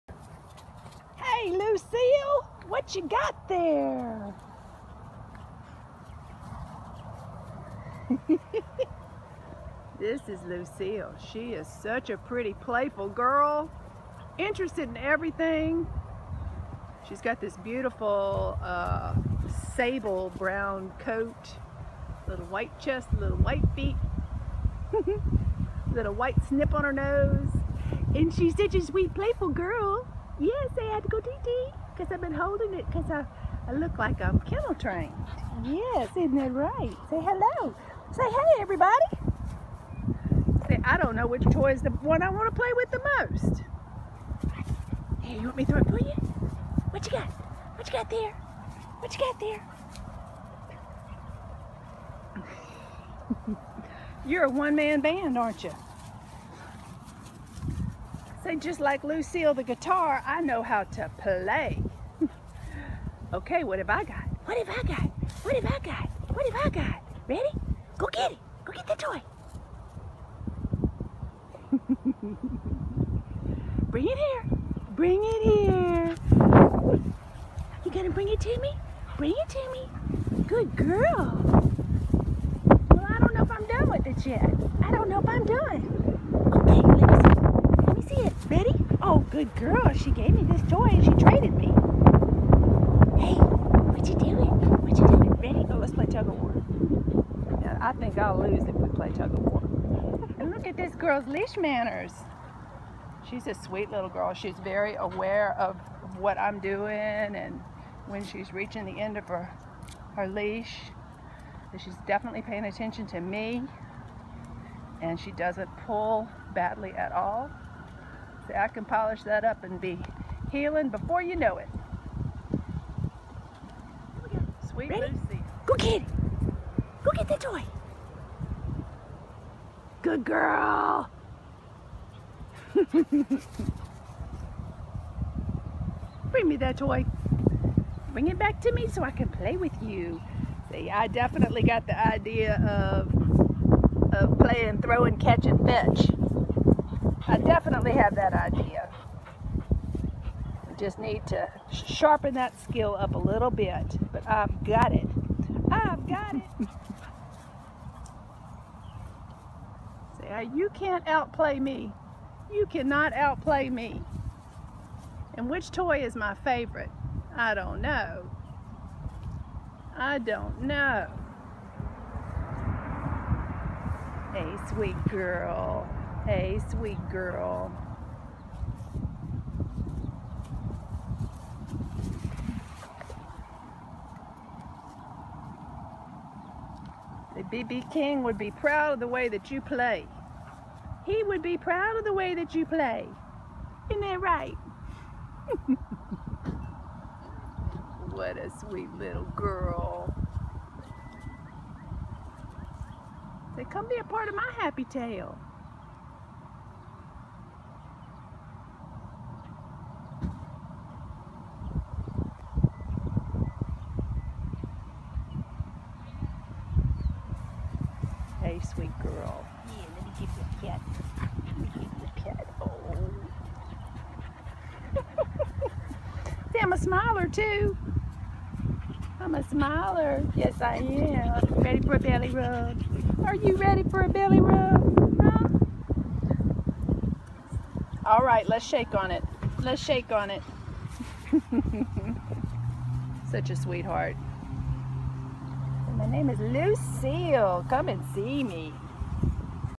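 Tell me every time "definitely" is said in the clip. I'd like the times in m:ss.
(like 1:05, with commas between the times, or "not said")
1:52, 2:21, 2:27.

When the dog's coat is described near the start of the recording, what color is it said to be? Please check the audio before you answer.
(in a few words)
sable brown.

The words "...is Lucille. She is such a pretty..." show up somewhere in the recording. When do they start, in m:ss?
0:10.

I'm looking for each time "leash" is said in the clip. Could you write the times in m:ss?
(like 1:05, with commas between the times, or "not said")
1:41, 1:50.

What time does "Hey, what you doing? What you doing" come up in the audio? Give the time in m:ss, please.
1:33.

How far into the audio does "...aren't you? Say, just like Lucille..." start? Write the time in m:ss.
0:55.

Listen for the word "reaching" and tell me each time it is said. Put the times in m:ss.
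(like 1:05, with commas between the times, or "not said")
1:48.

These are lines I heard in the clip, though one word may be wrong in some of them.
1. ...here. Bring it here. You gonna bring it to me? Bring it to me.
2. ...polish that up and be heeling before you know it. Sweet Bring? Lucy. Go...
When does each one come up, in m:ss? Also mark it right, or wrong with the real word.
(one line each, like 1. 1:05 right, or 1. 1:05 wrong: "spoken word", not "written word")
1. 1:14 right
2. 1:58 wrong: "Ready", not "Bring".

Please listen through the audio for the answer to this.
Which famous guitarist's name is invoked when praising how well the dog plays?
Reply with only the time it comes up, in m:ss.
3:07.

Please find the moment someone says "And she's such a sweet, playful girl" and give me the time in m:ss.
0:28.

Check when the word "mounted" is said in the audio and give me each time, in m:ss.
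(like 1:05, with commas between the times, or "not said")
not said.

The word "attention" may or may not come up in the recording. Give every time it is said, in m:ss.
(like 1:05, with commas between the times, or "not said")
1:52.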